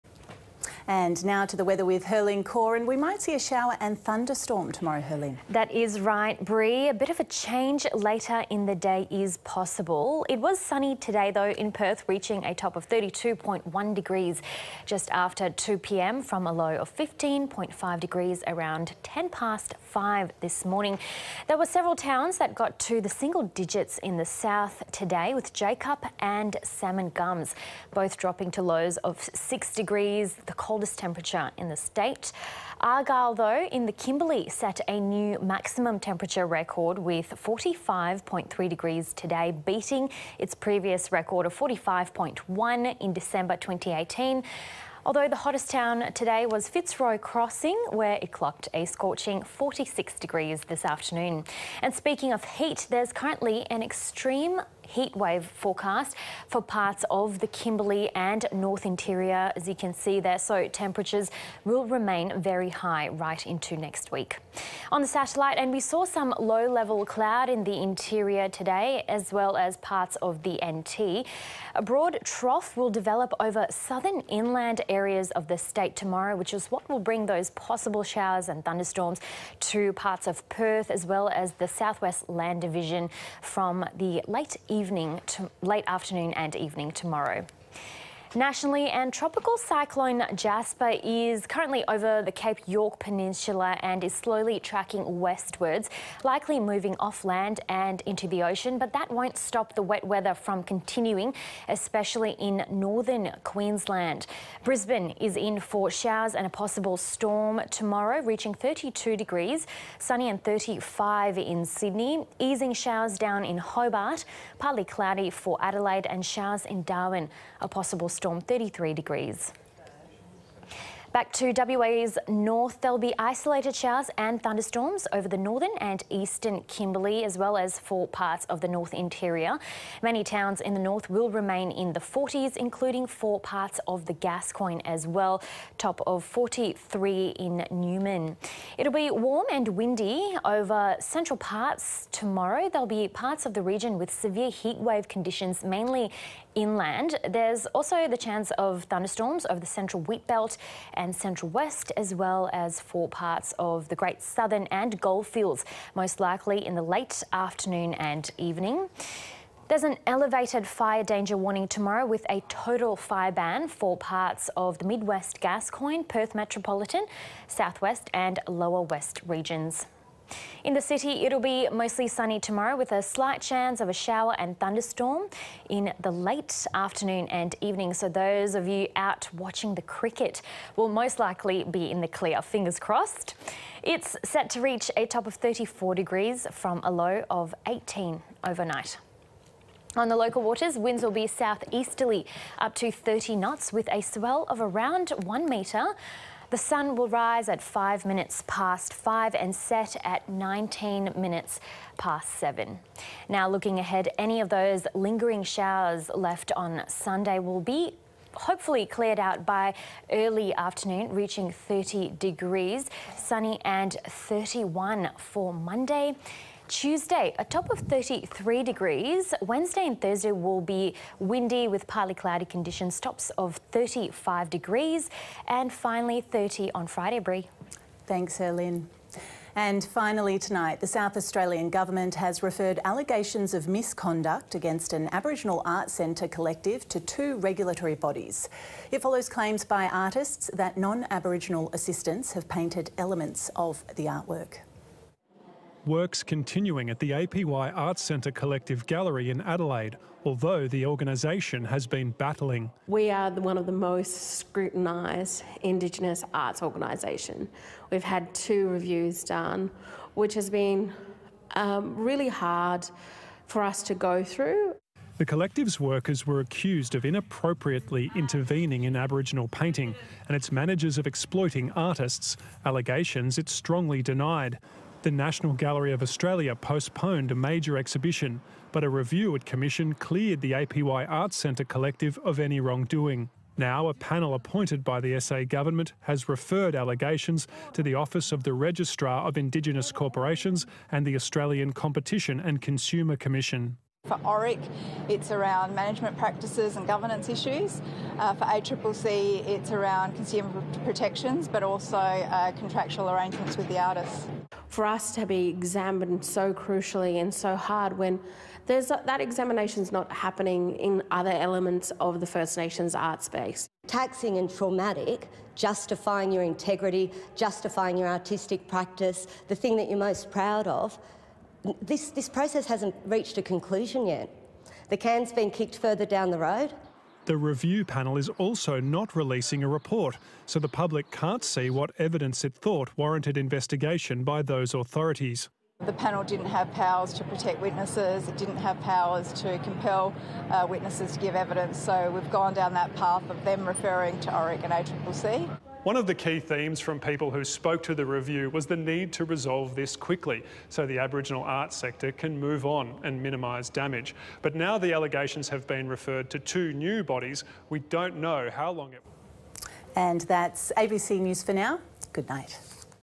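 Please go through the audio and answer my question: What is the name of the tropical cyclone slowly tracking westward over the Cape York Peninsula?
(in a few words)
Jasper.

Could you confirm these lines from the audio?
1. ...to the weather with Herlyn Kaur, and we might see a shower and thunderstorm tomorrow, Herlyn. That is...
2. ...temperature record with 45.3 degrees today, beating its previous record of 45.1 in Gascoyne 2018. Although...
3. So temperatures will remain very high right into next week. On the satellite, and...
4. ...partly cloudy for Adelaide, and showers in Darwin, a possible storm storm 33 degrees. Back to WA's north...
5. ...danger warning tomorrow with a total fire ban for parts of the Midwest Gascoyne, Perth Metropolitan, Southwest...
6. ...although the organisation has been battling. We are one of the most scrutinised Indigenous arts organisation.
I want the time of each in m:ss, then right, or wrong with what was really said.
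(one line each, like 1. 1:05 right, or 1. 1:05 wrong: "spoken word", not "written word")
1. 0:01 right
2. 0:35 wrong: "December", not "Gascoyne"
3. 1:00 right
4. 1:54 right
5. 2:41 right
6. 4:10 right.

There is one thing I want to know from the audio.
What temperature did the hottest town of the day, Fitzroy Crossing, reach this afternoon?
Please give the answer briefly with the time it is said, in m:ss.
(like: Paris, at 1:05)
46 degrees, at 0:49.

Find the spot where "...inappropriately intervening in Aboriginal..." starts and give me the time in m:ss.
4:27.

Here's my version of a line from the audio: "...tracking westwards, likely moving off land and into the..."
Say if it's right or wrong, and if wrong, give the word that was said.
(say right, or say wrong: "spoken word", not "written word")
right.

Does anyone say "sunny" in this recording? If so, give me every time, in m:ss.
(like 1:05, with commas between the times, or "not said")
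0:10, 1:49, 2:52, 3:33.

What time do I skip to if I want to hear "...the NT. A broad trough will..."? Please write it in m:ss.
1:10.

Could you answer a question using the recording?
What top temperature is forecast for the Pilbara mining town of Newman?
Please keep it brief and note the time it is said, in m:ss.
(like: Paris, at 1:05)
43, at 2:16.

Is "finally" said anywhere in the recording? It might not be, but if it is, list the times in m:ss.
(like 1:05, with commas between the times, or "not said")
3:45, 3:49.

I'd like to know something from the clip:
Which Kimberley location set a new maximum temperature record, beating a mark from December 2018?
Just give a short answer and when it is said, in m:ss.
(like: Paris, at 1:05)
Argyle, at 0:32.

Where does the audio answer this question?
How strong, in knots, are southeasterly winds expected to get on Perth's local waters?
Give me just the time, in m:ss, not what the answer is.
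3:12.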